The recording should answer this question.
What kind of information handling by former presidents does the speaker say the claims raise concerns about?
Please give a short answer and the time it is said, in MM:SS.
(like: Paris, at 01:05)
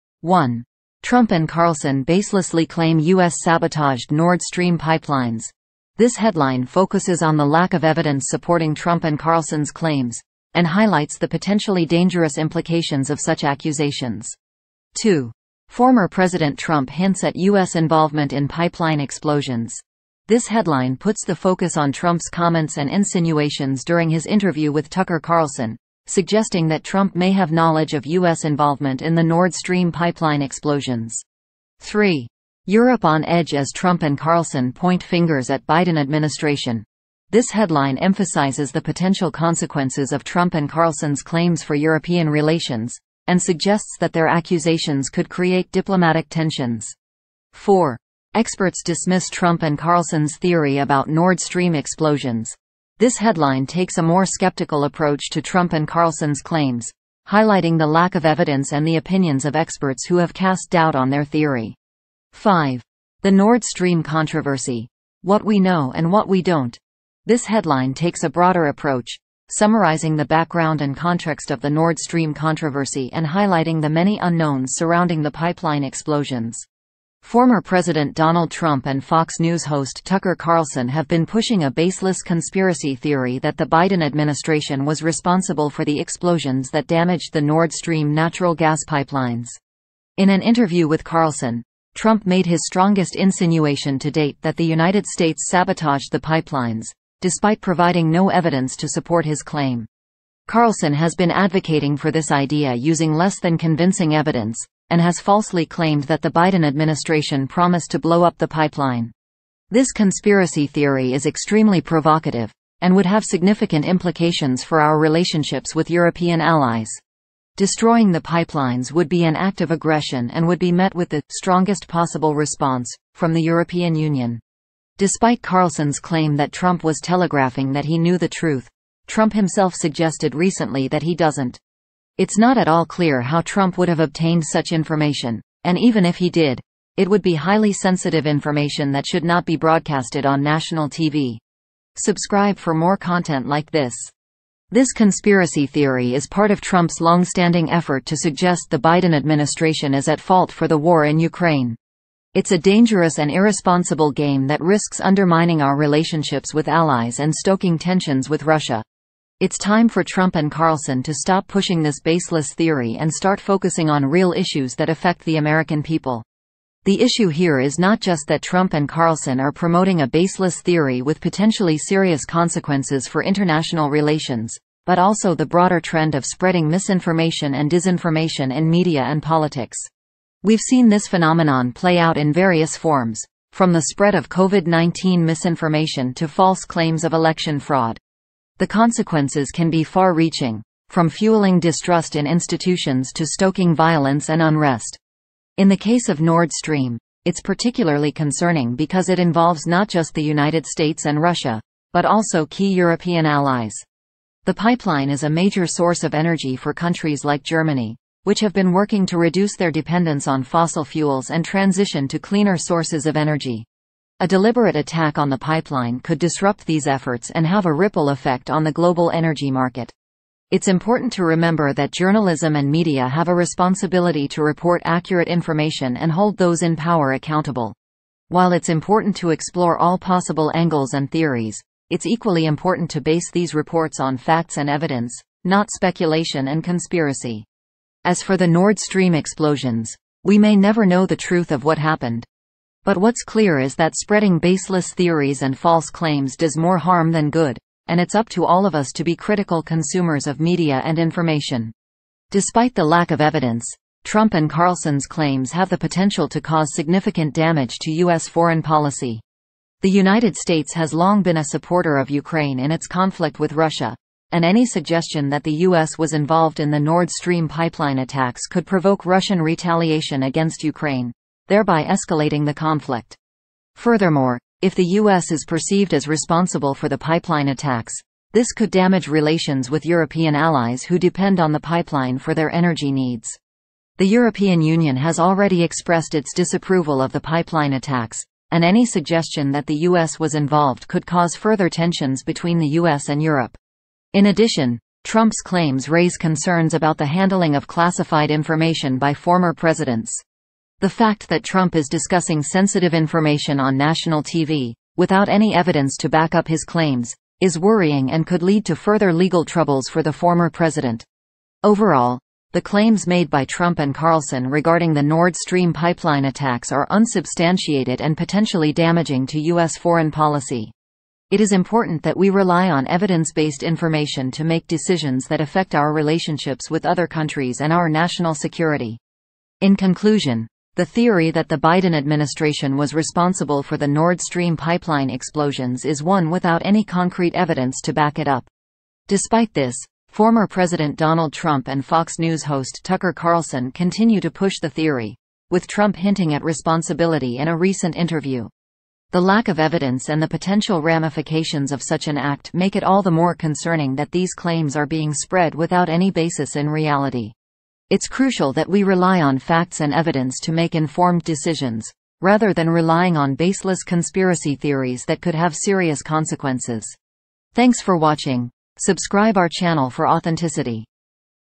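classified information, at 04:57.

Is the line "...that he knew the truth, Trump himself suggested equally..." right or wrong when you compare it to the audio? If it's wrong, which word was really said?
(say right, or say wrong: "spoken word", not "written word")
wrong: "recently", not "equally".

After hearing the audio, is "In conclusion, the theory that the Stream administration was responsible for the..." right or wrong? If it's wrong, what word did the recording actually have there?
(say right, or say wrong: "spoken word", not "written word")
wrong: "Biden", not "Stream".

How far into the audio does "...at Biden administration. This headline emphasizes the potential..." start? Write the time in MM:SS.
00:35.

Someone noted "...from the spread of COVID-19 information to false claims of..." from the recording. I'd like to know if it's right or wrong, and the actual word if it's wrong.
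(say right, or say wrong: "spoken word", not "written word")
wrong: "misinformation", not "information".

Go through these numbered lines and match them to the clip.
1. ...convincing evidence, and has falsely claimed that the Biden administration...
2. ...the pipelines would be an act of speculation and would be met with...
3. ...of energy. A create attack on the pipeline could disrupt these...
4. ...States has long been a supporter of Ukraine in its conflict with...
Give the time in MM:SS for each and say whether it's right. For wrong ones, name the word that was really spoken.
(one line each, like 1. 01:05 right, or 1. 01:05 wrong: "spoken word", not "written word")
1. 01:43 right
2. 01:58 wrong: "aggression", not "speculation"
3. 03:33 wrong: "deliberate", not "create"
4. 04:20 right.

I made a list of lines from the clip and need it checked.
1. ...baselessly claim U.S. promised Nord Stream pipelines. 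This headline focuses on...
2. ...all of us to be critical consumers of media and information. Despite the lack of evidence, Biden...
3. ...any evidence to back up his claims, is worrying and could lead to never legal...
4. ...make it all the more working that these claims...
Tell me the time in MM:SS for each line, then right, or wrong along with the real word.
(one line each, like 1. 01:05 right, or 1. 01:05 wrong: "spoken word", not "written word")
1. 00:02 wrong: "sabotaged", not "promised"
2. 04:08 wrong: "Trump", not "Biden"
3. 05:05 wrong: "further", not "never"
4. 05:52 wrong: "concerning", not "working".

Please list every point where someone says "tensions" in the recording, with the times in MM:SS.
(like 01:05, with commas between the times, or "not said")
00:46, 02:37, 04:51.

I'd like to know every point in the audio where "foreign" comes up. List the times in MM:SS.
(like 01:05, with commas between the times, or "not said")
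04:18, 05:19.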